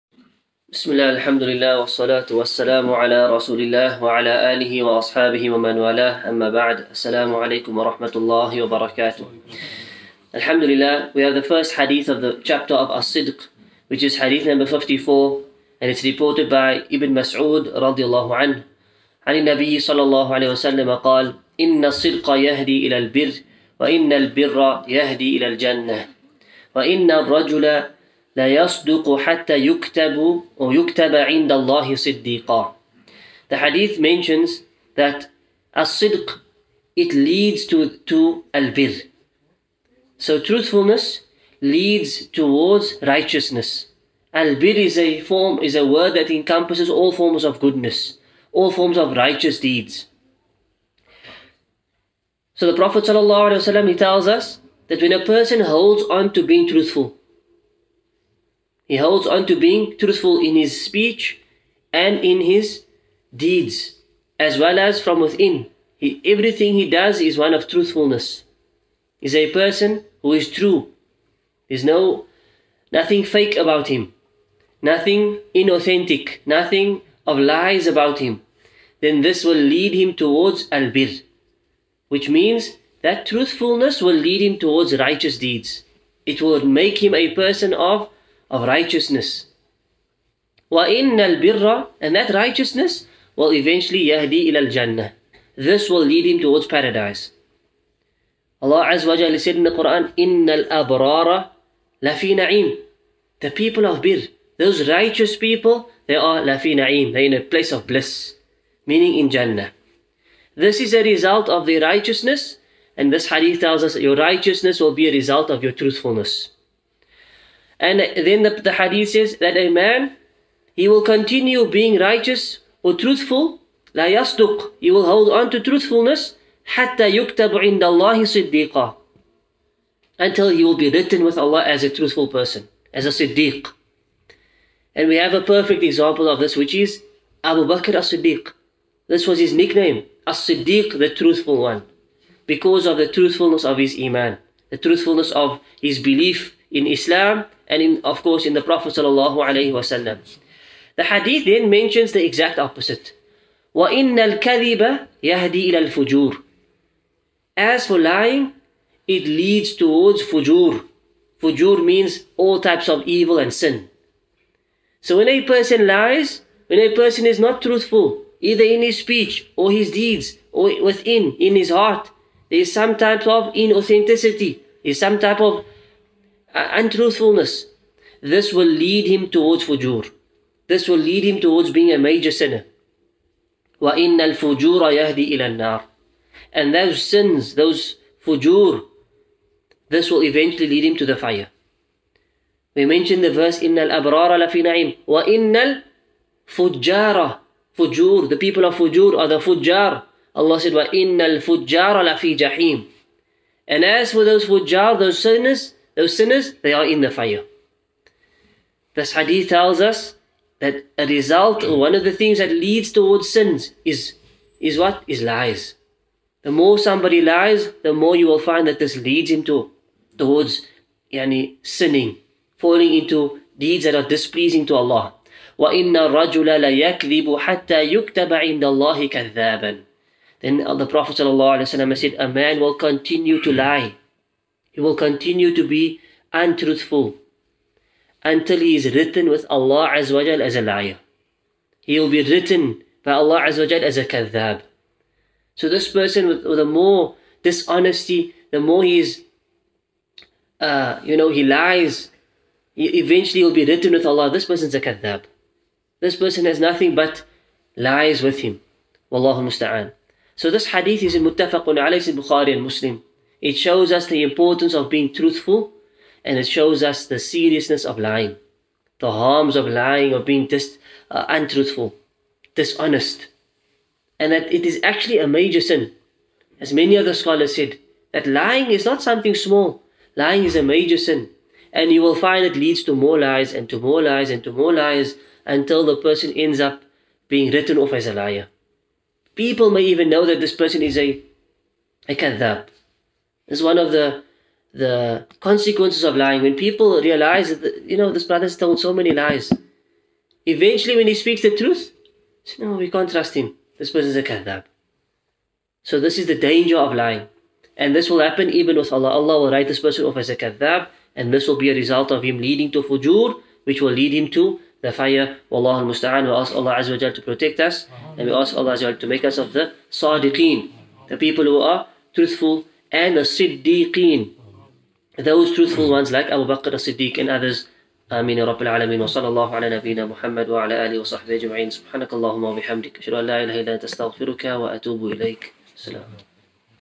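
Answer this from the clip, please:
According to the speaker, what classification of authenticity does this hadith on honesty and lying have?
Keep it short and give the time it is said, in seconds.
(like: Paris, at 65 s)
Muttafaqun alayhi, at 261 s.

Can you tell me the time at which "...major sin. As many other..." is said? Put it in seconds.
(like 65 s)
275 s.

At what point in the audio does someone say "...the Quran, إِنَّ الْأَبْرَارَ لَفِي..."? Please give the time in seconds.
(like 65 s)
99 s.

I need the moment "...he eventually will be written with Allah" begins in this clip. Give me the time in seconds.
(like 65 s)
252 s.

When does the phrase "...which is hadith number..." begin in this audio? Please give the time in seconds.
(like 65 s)
13 s.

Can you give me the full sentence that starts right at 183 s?
وَإِنَّ الْفُجُورَ يَهْدِي إِلَى النَّارِ And those sins, those fujur, this will eventually lead him to the fire.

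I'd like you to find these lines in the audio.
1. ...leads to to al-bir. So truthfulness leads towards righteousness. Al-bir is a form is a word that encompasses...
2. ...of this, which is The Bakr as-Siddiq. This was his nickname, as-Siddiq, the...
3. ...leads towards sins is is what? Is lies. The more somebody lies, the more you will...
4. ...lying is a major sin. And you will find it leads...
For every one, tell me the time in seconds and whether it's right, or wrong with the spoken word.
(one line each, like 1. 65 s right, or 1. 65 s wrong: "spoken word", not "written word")
1. 37 s right
2. 136 s wrong: "Abu", not "The"
3. 212 s right
4. 280 s right.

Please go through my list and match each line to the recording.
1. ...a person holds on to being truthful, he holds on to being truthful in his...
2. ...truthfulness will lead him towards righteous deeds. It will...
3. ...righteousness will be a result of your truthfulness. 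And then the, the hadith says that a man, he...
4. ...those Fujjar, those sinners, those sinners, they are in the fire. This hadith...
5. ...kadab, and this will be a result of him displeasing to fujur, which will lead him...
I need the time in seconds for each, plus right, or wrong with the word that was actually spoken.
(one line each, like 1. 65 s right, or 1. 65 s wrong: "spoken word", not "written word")
1. 55 s right
2. 83 s right
3. 114 s right
4. 204 s right
5. 310 s wrong: "leading", not "displeasing".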